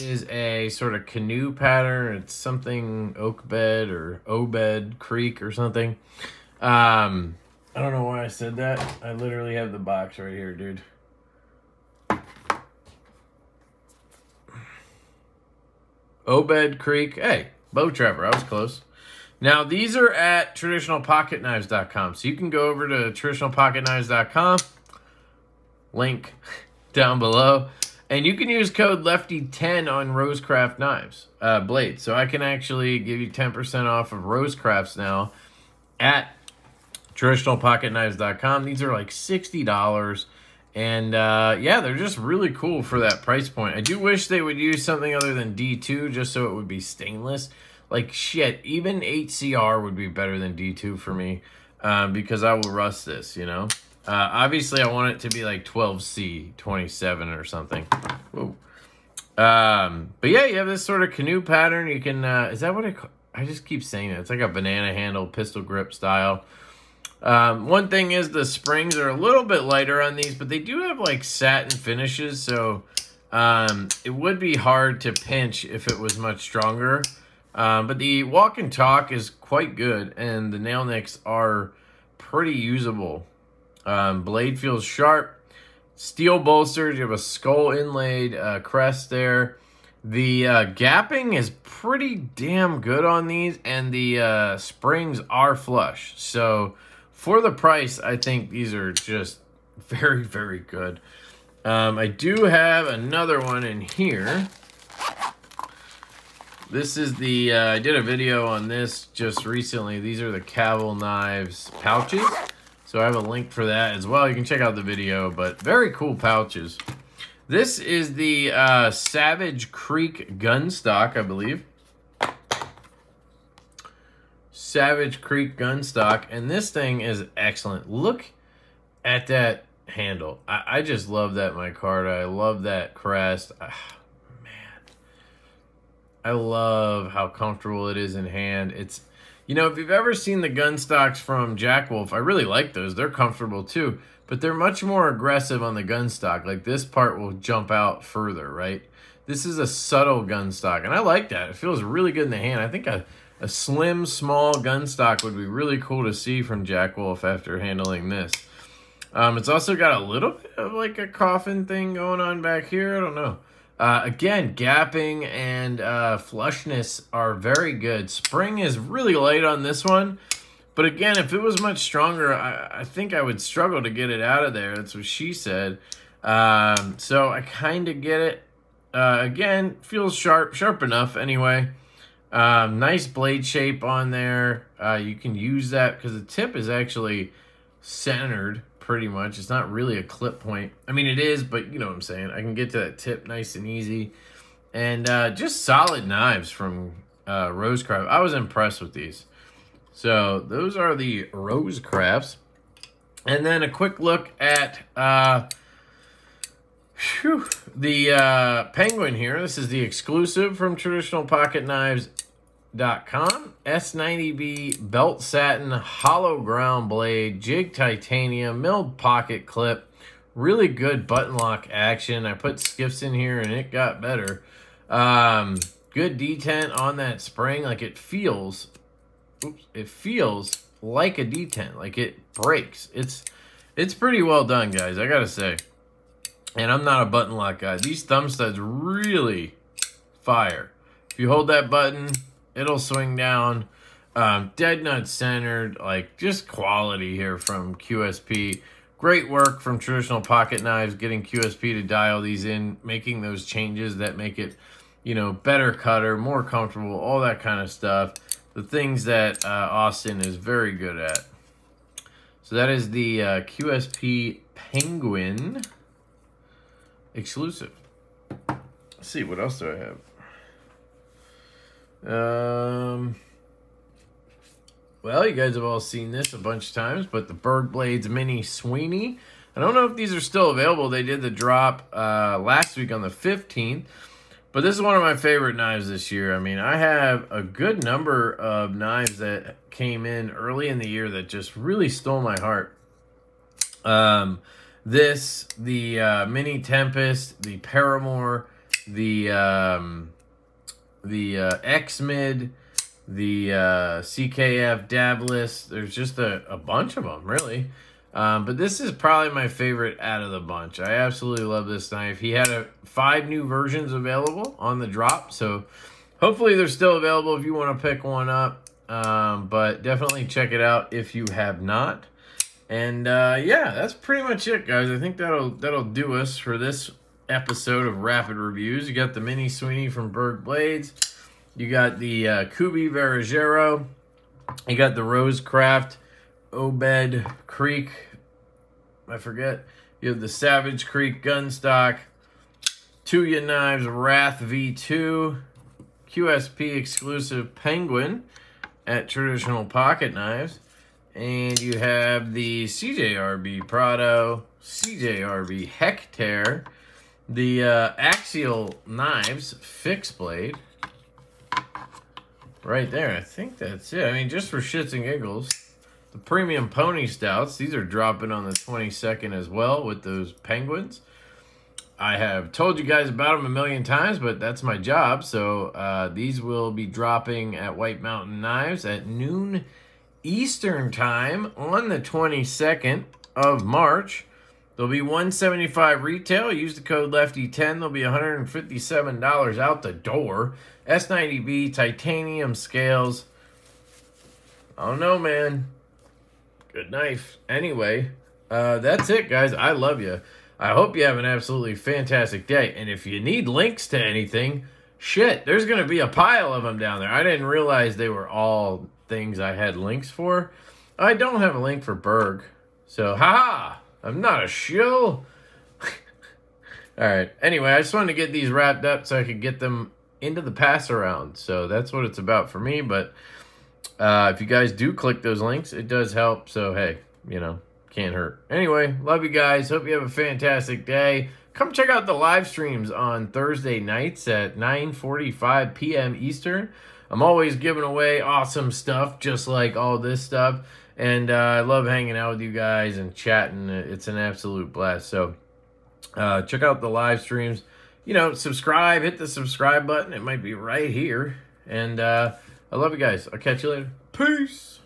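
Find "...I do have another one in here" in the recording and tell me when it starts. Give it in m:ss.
1:41.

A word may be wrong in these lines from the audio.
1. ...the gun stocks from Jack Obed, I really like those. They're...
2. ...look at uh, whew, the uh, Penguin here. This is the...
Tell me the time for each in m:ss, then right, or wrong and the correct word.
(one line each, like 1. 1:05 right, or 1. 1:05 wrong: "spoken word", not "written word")
1. 2:20 wrong: "Wolf", not "Obed"
2. 3:23 right.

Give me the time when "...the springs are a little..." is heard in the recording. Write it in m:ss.
1:08.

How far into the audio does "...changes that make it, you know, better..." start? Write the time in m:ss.
4:13.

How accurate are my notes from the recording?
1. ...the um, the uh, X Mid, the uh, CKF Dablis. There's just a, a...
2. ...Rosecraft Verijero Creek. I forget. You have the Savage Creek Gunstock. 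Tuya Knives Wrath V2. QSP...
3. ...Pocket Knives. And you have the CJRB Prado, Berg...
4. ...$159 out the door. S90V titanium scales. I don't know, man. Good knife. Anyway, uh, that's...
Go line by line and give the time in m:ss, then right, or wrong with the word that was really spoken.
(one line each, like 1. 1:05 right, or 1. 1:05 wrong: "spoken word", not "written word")
1. 4:58 right
2. 5:35 wrong: "Obed", not "Verijero"
3. 5:49 wrong: "CJRB", not "Berg"
4. 6:28 wrong: "157", not "159".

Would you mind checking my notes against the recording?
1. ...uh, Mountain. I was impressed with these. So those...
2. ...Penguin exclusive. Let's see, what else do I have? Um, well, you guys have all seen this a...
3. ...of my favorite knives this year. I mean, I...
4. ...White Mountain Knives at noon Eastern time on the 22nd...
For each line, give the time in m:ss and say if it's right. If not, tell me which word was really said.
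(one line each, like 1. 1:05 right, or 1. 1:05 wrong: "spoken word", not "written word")
1. 3:17 wrong: "Rosecraft", not "Mountain"
2. 4:24 right
3. 4:44 right
4. 6:17 right.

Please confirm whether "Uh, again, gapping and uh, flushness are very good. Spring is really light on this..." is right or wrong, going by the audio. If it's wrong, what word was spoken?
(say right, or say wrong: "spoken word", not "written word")
right.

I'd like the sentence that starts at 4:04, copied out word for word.
Um, dead nut centered, like just quality here from QSP.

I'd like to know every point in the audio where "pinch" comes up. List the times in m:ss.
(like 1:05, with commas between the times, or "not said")
1:15.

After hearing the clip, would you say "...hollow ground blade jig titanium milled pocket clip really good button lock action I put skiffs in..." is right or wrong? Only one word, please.
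right.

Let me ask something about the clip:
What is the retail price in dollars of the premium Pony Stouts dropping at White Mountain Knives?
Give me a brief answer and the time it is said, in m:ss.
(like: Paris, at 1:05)
$175, at 6:25.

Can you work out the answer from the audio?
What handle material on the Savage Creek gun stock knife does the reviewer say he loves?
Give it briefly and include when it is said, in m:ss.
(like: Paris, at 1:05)
micarta, at 2:11.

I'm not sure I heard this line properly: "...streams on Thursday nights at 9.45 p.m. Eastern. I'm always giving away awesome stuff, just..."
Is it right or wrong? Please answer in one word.
right.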